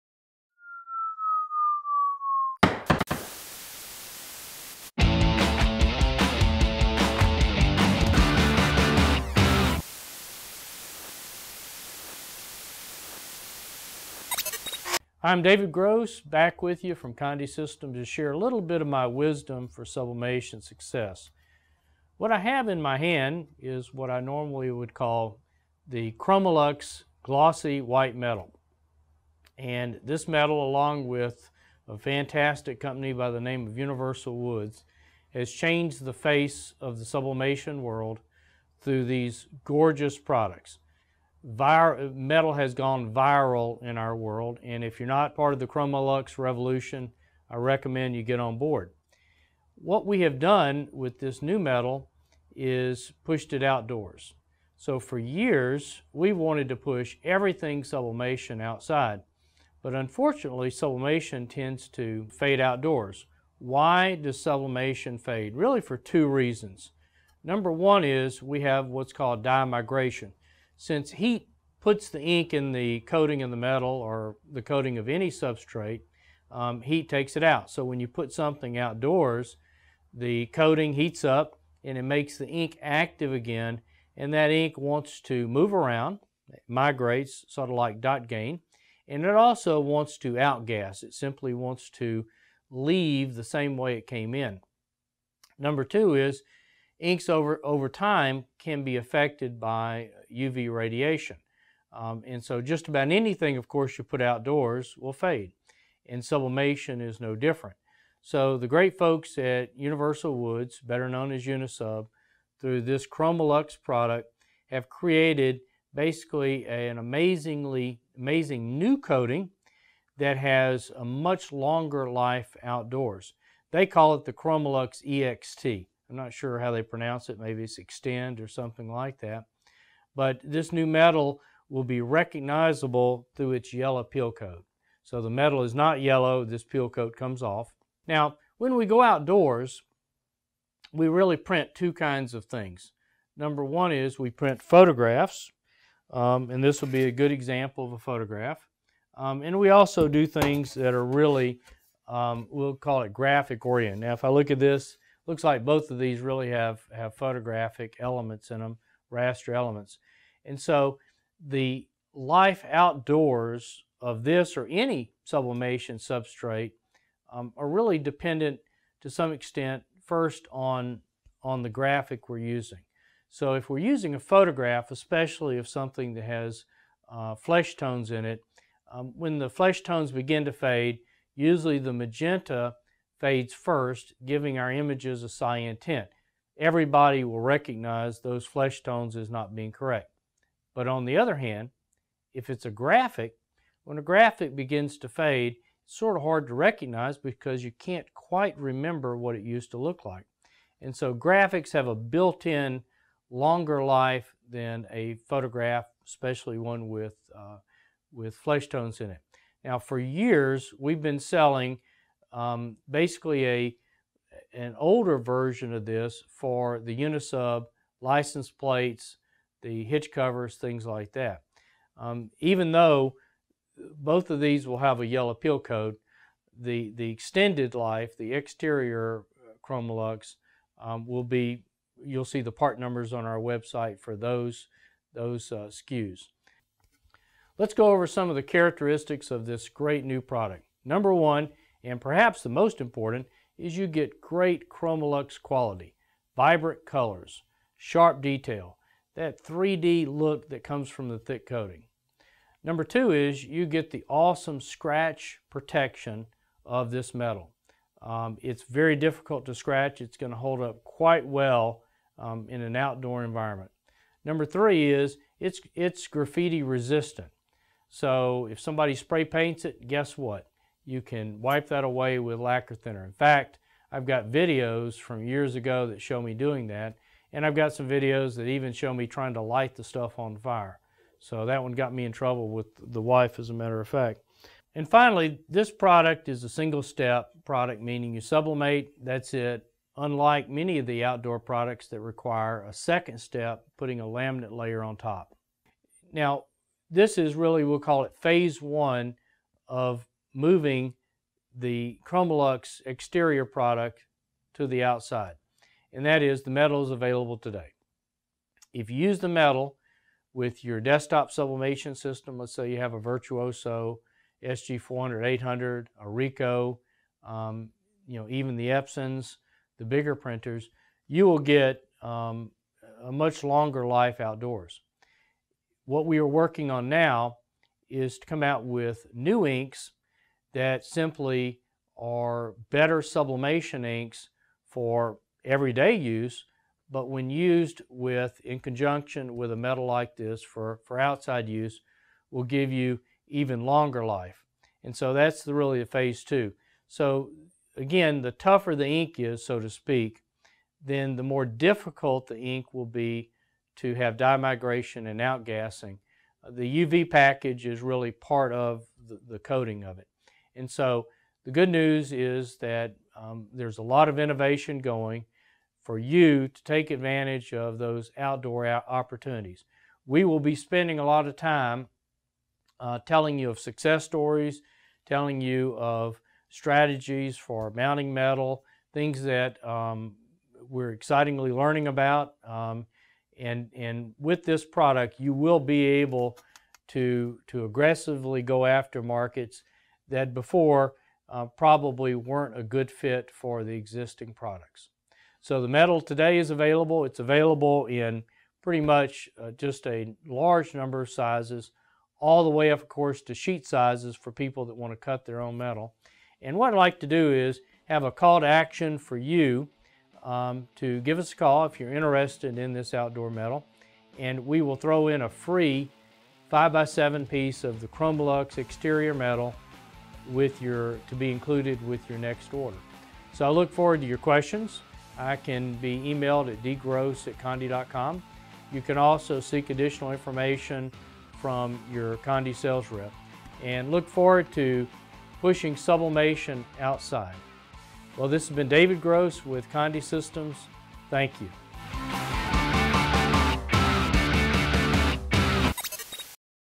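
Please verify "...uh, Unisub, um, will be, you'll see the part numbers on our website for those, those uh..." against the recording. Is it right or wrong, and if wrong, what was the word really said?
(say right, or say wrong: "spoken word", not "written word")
wrong: "ChromaLuxe", not "Unisub".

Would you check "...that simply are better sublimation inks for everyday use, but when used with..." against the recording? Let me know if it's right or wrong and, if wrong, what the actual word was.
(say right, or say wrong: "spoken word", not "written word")
right.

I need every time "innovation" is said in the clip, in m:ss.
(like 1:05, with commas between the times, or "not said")
6:04.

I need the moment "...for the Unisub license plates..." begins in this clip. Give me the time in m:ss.
3:36.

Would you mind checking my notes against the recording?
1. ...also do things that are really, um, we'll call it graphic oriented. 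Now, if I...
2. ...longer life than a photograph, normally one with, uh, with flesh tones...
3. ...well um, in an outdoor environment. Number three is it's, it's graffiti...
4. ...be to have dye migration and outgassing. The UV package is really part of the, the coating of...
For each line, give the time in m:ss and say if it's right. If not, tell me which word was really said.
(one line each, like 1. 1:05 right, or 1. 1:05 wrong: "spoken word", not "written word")
1. 2:29 right
2. 3:23 wrong: "especially", not "normally"
3. 4:21 right
4. 5:52 right.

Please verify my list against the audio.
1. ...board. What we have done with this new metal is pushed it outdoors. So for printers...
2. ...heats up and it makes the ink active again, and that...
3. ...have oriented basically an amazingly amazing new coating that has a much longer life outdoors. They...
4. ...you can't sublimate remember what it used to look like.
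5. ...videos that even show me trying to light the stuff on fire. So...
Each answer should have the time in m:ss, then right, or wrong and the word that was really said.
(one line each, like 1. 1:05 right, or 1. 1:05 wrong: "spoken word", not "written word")
1. 0:48 wrong: "years", not "printers"
2. 1:20 right
3. 1:54 wrong: "created", not "oriented"
4. 3:17 wrong: "quite", not "sublimate"
5. 4:37 right.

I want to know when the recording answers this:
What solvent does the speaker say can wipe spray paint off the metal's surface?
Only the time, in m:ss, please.
4:32.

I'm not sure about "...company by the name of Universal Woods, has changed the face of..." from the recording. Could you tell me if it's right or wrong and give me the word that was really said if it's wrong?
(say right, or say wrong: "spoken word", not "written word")
right.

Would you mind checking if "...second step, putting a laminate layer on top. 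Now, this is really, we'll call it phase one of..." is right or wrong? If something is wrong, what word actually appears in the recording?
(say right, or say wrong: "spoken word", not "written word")
right.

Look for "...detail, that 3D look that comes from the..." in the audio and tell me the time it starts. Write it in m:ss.
4:08.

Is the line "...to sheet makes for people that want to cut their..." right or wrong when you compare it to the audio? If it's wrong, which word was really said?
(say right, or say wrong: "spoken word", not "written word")
wrong: "sizes", not "makes".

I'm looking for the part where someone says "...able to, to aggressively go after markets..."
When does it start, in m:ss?
6:25.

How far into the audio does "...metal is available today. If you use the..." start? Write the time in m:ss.
5:06.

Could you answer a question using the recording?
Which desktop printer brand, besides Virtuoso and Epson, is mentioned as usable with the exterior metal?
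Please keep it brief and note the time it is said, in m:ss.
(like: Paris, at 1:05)
Ricoh, at 5:16.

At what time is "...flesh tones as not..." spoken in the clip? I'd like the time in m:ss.
3:08.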